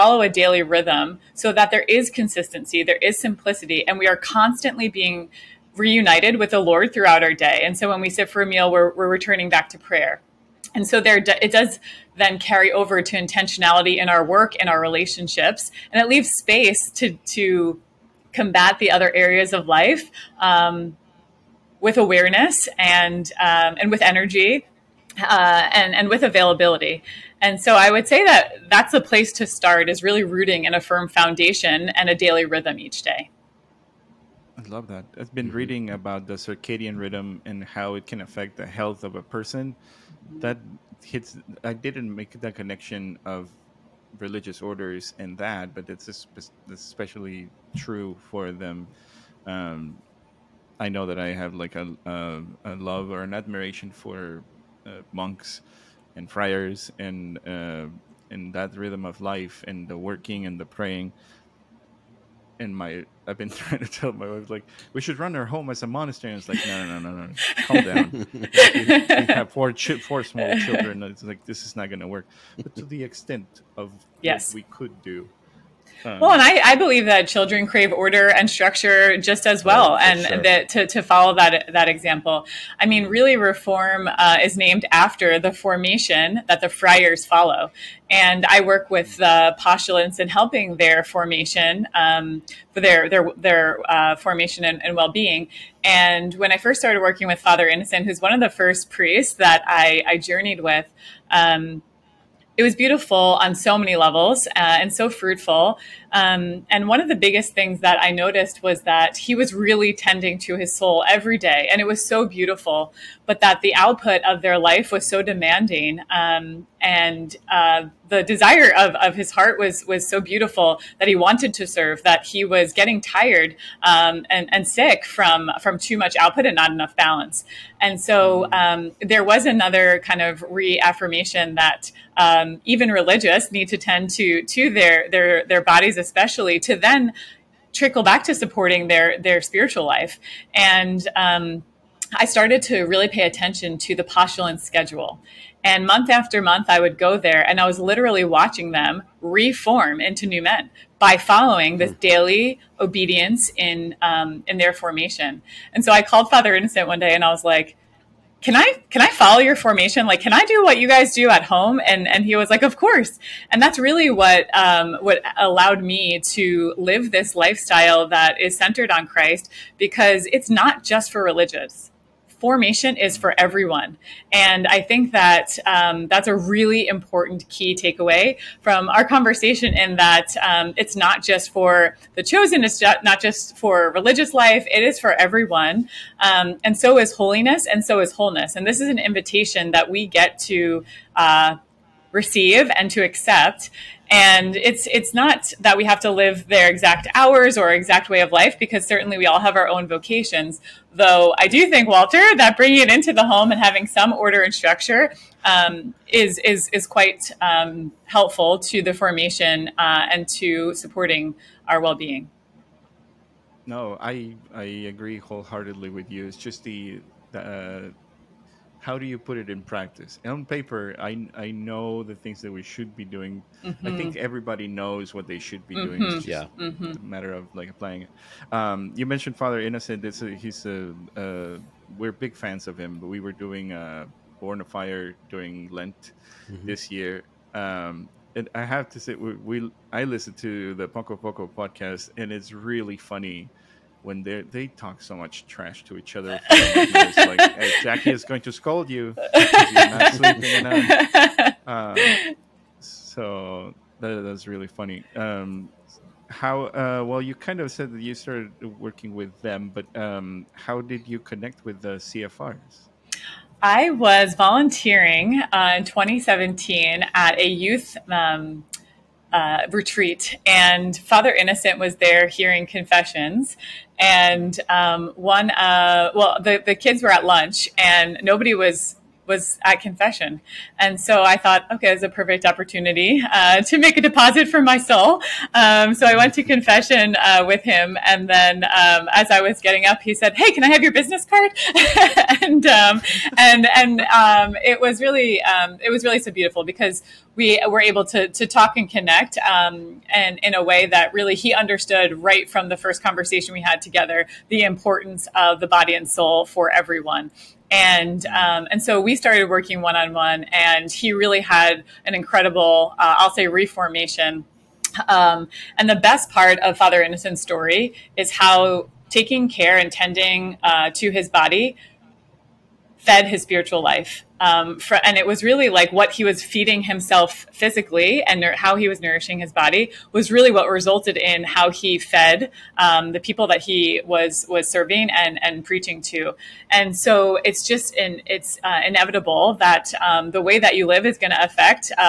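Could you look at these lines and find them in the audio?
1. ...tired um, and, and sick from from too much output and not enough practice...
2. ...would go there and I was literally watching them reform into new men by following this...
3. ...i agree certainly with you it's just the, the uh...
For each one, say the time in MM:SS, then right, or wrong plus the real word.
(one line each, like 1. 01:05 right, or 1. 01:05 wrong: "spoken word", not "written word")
1. 02:03 wrong: "balance", not "practice"
2. 02:26 right
3. 03:34 wrong: "wholeheartedly", not "certainly".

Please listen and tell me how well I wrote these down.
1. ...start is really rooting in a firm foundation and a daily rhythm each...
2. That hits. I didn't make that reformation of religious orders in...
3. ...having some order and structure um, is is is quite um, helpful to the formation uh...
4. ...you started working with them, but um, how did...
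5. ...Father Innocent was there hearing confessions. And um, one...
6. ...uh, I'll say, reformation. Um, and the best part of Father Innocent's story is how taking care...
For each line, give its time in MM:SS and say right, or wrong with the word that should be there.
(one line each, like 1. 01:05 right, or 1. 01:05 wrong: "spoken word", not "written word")
1. 00:29 right
2. 00:40 wrong: "connection", not "reformation"
3. 03:23 right
4. 04:17 right
5. 04:30 right
6. 05:12 right.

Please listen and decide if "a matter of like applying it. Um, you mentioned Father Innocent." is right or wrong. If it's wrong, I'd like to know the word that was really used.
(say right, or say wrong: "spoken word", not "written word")
right.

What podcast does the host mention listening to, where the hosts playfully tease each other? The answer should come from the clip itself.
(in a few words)
Poco Poco.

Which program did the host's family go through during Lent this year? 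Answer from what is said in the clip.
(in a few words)
Born of Fire.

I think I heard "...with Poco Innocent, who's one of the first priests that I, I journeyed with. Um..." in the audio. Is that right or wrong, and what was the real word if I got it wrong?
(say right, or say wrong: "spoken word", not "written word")
wrong: "Father", not "Poco".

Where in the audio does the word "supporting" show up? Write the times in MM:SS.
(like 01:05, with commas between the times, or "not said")
02:18, 03:30.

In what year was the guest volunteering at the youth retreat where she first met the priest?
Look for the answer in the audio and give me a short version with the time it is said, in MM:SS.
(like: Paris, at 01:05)
2017, at 04:25.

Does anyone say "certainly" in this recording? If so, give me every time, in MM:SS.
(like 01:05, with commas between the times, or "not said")
03:18.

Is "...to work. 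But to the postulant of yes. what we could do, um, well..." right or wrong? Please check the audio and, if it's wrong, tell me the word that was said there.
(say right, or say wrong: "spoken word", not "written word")
wrong: "extent", not "postulant".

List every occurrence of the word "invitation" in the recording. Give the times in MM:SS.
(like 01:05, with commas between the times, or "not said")
03:08.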